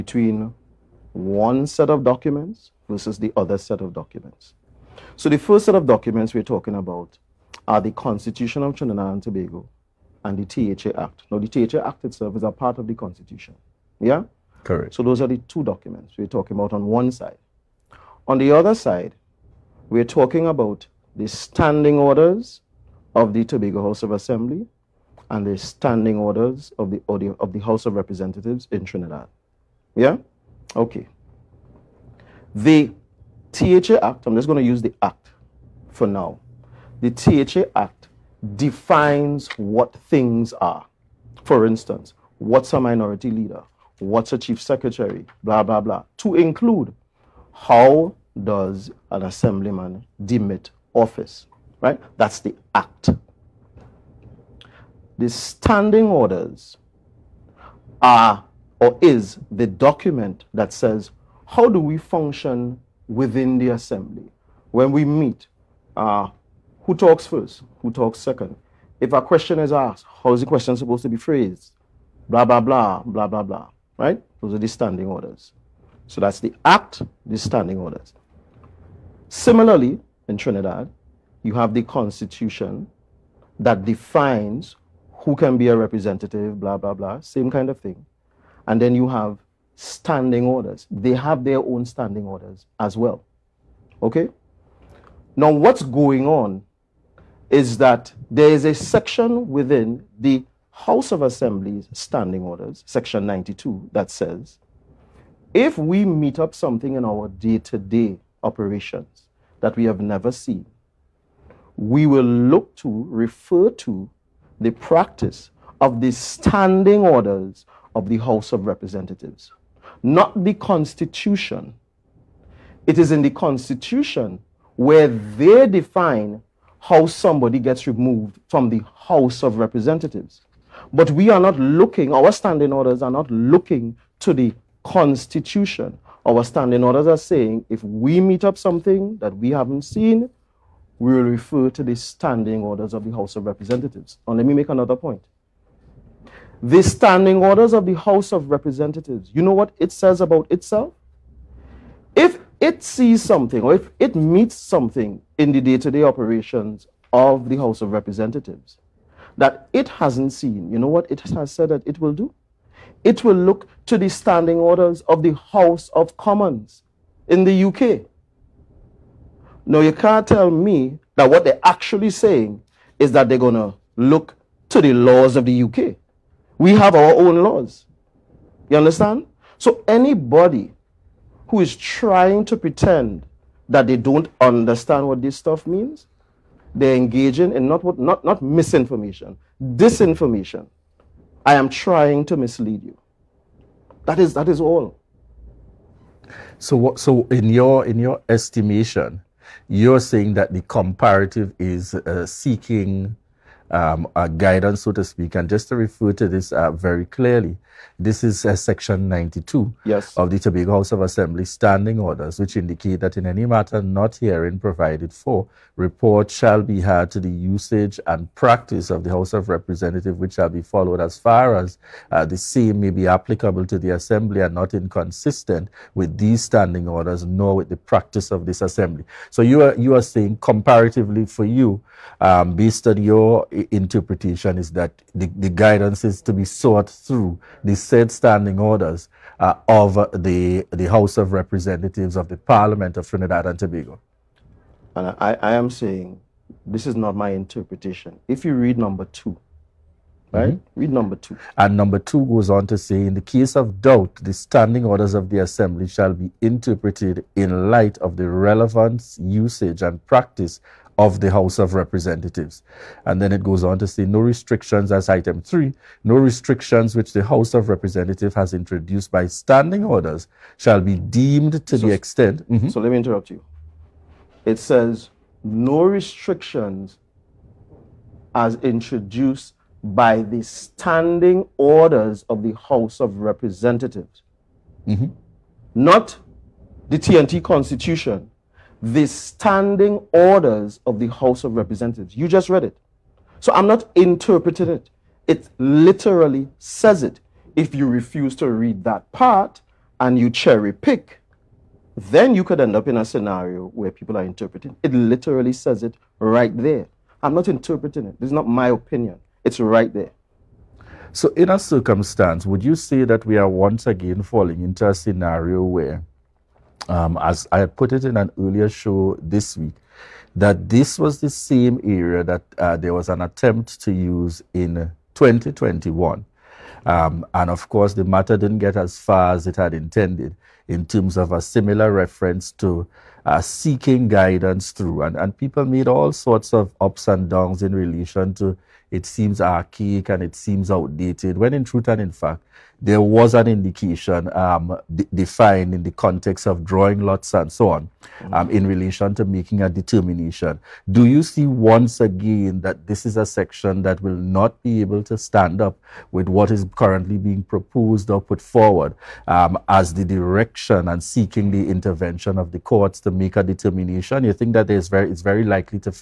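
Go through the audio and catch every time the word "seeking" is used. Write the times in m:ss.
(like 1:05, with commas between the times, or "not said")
3:22, 5:33, 6:01.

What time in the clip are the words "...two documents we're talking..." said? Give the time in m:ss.
0:15.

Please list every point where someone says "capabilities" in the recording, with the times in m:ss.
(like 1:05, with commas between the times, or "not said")
not said.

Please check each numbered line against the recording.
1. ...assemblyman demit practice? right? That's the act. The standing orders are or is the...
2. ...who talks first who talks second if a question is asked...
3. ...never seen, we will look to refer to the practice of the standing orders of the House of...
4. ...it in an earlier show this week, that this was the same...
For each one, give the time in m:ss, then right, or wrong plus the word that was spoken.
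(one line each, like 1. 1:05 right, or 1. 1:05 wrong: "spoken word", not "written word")
1. 0:49 wrong: "office", not "practice"
2. 1:06 right
3. 1:50 right
4. 5:17 right.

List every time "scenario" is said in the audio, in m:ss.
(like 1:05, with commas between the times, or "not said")
5:03, 5:14.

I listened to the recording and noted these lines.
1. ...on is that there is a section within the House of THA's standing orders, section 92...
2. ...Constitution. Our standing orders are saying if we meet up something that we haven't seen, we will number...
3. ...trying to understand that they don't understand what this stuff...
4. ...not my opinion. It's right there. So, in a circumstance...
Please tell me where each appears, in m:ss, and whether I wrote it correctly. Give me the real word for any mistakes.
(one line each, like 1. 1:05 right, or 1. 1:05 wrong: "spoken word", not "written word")
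1. 1:36 wrong: "Assembly", not "THA"
2. 2:14 wrong: "refer", not "number"
3. 3:01 wrong: "pretend", not "understand"
4. 5:08 right.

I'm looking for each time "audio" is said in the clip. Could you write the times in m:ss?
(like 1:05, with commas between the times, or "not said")
0:27.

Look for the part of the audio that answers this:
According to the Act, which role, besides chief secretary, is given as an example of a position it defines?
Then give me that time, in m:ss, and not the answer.
0:42.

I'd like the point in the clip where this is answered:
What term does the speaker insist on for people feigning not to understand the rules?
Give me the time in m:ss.
3:09.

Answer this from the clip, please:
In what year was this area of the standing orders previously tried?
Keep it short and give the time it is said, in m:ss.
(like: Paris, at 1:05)
2021, at 5:25.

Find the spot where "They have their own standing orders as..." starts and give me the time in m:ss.
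1:30.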